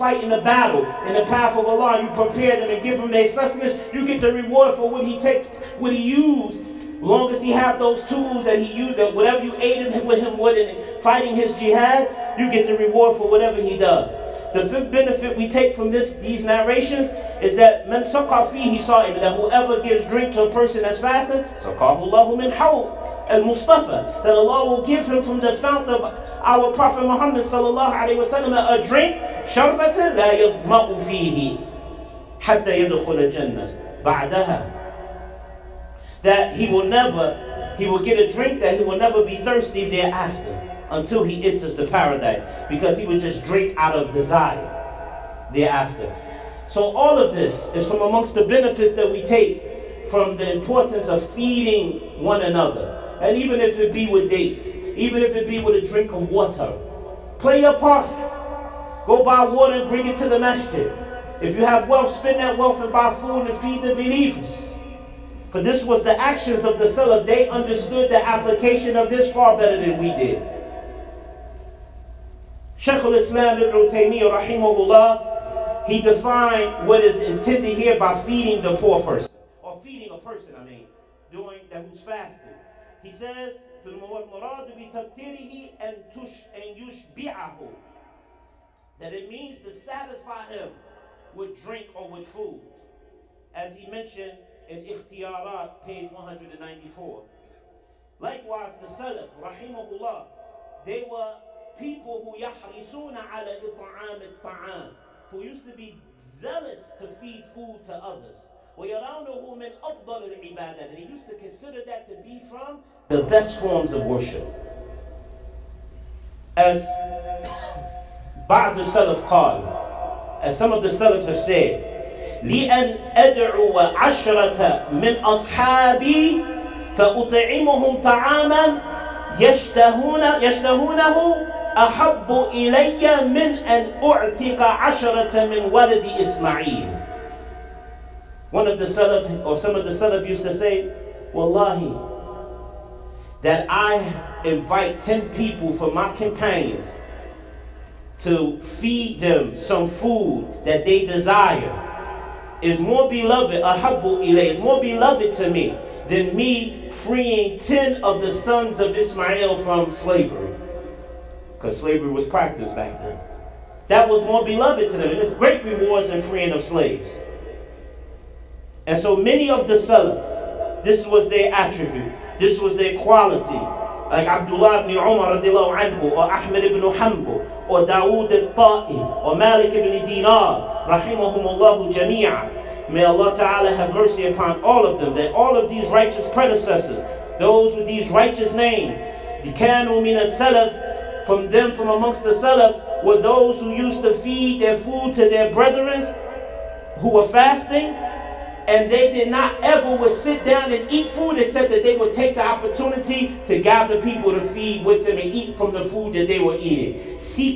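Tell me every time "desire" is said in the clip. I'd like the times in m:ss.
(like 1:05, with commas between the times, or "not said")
0:44, 2:31.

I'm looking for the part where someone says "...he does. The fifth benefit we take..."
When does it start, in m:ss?
0:13.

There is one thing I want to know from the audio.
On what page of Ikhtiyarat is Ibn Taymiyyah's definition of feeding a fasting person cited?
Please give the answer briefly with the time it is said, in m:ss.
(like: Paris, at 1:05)
194, at 1:36.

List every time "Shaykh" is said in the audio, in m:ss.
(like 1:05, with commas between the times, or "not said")
1:12.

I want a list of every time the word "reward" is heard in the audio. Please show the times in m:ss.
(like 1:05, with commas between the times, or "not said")
0:04, 0:12, 2:45.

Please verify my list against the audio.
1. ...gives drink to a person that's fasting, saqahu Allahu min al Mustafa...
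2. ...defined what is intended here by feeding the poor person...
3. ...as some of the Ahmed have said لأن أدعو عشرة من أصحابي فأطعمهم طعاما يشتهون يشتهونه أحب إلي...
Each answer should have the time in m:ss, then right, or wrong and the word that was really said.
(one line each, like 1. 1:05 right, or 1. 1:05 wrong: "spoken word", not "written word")
1. 0:19 right
2. 1:16 right
3. 2:00 wrong: "Salaf", not "Ahmed".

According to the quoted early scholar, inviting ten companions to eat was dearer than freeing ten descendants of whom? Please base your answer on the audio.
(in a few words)
Ismael.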